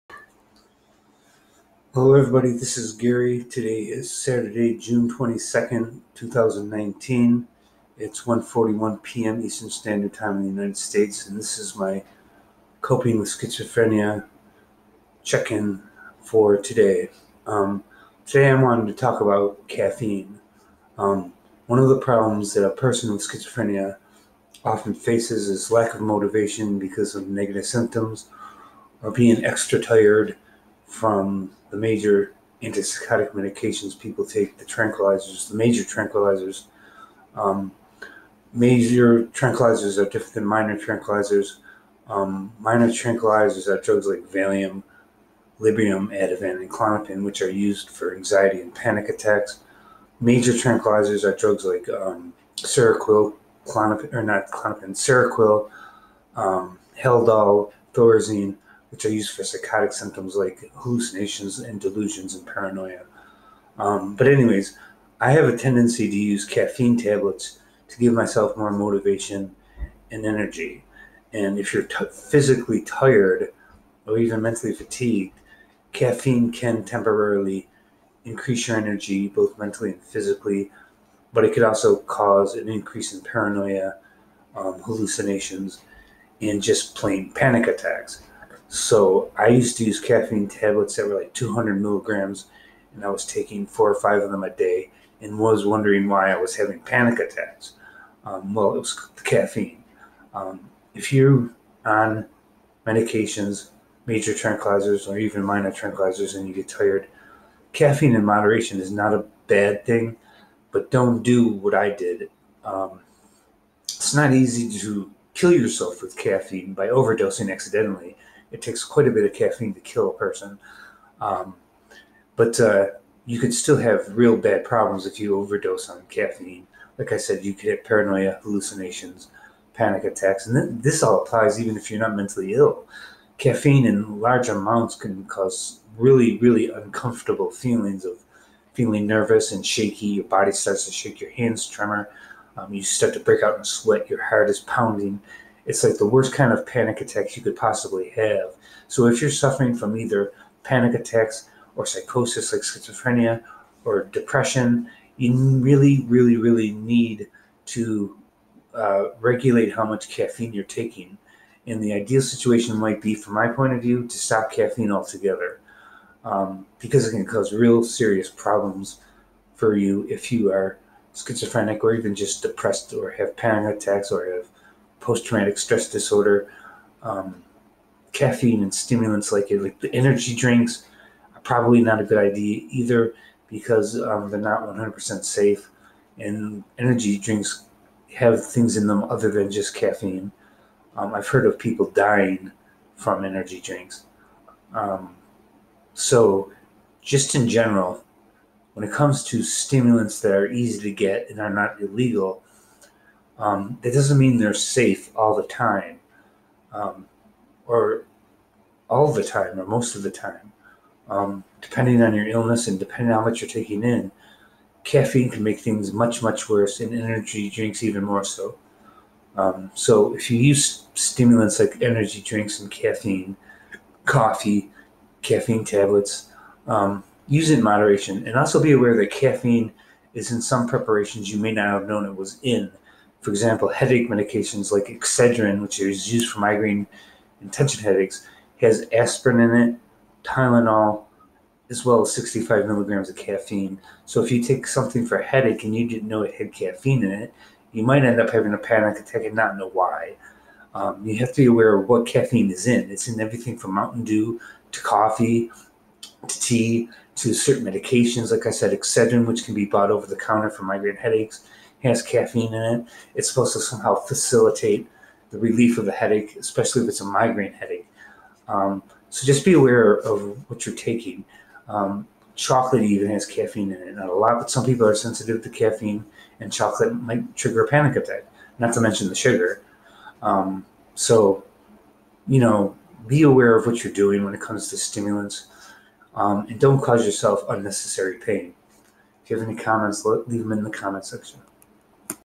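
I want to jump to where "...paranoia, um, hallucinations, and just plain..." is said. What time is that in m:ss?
1:23.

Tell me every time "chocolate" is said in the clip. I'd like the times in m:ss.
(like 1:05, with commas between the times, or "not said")
4:32, 4:36.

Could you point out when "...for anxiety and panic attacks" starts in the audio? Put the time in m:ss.
0:47.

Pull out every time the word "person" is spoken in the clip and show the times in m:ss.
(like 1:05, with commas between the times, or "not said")
0:22, 2:00.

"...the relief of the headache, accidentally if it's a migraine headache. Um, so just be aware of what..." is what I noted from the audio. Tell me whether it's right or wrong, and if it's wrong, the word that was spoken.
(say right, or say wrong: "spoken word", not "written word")
wrong: "especially", not "accidentally".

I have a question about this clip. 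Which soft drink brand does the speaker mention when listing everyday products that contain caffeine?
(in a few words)
Mountain Dew.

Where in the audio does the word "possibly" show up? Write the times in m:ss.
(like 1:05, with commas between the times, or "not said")
2:27.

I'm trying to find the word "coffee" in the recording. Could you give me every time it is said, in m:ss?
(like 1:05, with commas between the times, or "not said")
3:44, 4:14.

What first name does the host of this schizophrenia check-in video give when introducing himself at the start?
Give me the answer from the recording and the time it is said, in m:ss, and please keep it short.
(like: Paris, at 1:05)
Gary, at 0:02.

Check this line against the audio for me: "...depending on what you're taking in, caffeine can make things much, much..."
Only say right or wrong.
right.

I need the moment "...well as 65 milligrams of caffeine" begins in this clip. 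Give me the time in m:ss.
4:01.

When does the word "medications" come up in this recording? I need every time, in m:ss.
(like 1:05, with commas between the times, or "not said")
0:33, 1:42, 3:54, 4:17.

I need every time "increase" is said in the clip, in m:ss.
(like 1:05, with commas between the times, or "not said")
1:18, 1:22.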